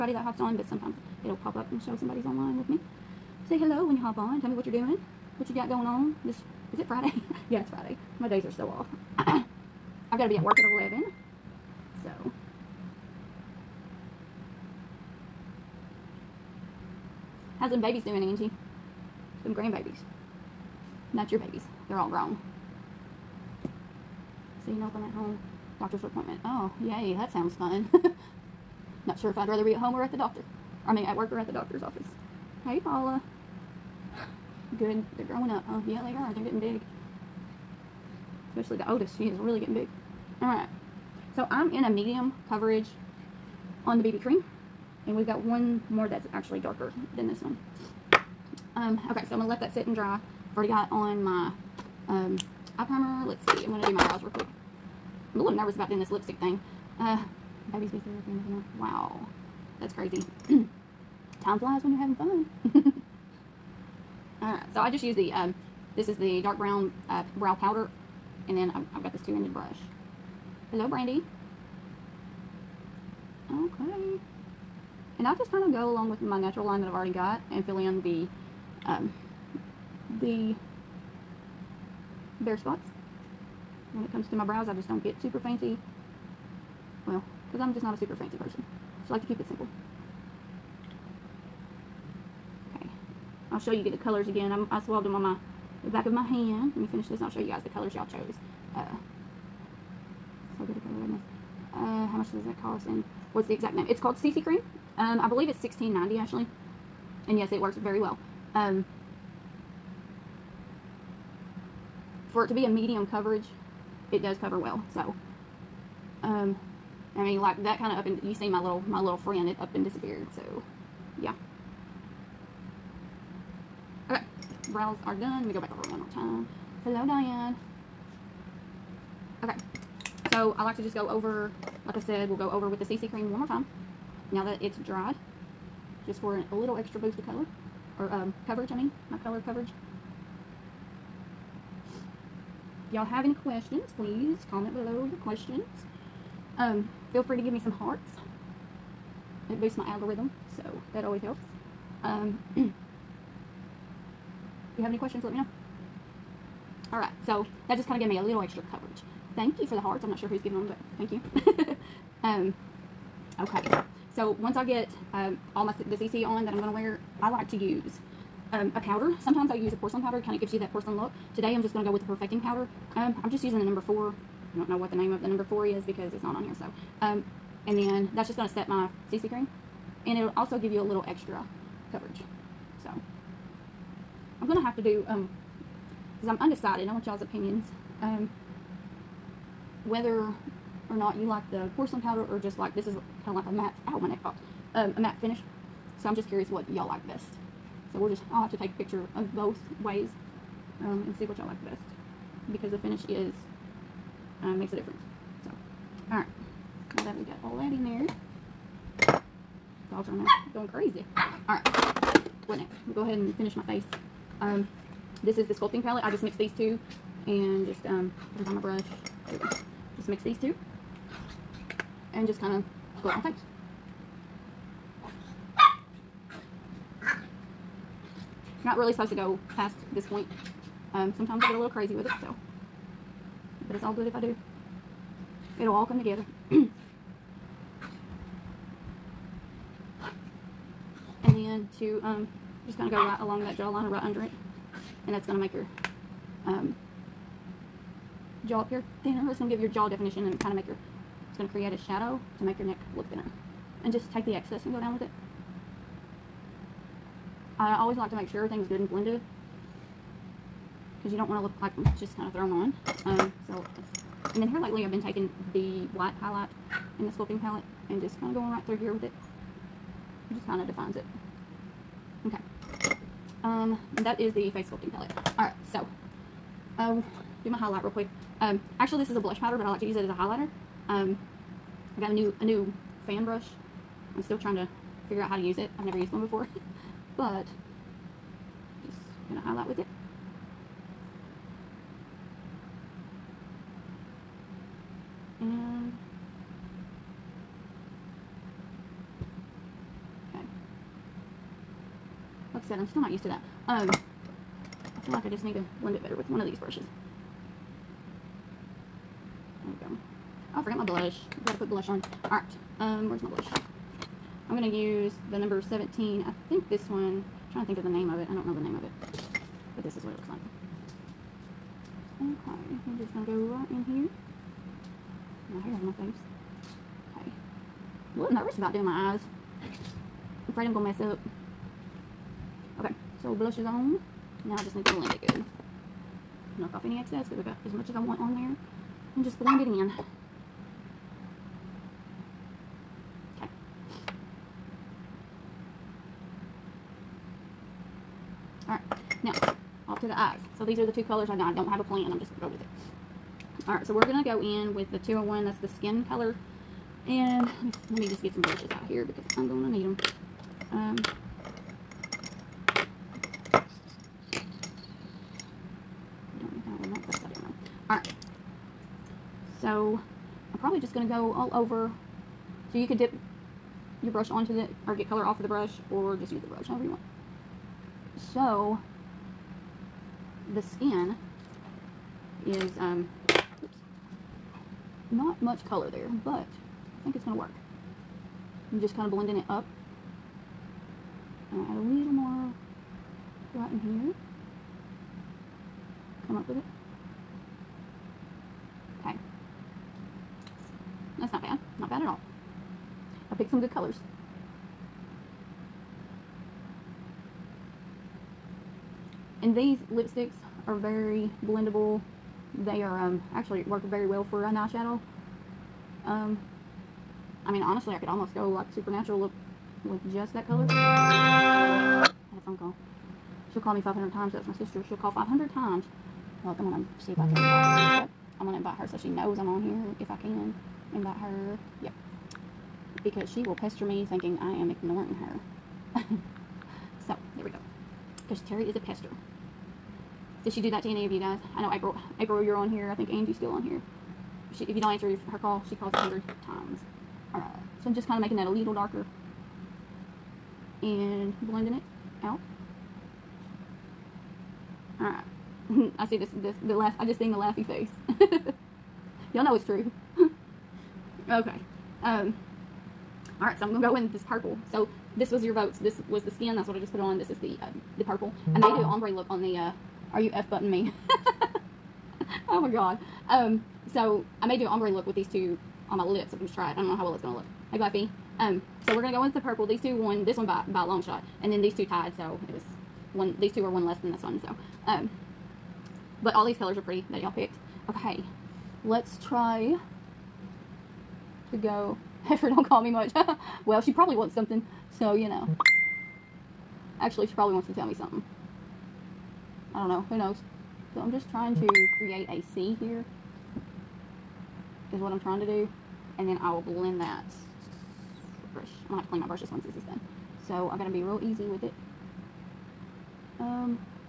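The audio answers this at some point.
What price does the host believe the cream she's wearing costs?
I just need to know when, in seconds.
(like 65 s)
105 s.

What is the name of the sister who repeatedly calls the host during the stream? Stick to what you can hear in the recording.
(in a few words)
Terry.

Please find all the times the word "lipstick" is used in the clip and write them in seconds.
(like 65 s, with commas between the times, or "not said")
56 s, 409 s.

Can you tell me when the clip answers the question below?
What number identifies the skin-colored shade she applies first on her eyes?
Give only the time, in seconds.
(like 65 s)
355 s.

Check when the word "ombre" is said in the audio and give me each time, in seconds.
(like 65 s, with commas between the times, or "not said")
468 s, 474 s.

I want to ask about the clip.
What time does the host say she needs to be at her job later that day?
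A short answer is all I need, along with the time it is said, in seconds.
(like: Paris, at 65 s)
11, at 10 s.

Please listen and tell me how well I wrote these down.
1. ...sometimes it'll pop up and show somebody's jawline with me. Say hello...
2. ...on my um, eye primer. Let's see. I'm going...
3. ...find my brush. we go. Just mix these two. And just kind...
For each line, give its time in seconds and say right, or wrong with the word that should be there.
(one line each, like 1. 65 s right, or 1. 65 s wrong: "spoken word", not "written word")
1. 0 s wrong: "online", not "jawline"
2. 50 s right
3. 218 s right.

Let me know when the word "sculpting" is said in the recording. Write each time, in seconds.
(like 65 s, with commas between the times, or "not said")
215 s, 267 s, 274 s.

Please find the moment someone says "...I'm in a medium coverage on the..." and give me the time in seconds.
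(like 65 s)
41 s.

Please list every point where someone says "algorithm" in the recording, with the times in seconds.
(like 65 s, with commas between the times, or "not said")
149 s.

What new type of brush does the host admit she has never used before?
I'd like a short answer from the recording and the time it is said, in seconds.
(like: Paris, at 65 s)
fan brush, at 283 s.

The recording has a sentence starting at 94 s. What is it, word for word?
I'm, I swabbed them on my the back of my hand.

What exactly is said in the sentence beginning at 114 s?
So, um, I mean, like that kind of up and you see my little my little friend, it up and disappeared.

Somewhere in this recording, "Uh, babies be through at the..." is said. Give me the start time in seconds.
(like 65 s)
56 s.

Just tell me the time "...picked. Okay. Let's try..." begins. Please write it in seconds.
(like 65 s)
487 s.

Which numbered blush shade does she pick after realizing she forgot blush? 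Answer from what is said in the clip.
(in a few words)
17.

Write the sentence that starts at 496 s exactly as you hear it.
Actually, she probably wants to tell me something.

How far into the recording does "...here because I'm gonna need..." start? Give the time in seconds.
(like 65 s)
358 s.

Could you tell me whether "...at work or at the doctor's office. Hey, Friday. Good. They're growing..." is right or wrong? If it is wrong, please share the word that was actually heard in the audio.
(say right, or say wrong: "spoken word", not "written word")
wrong: "Paula", not "Friday".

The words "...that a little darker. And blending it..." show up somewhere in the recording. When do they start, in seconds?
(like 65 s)
448 s.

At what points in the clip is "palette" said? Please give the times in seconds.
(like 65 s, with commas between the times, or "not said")
215 s, 267 s, 274 s.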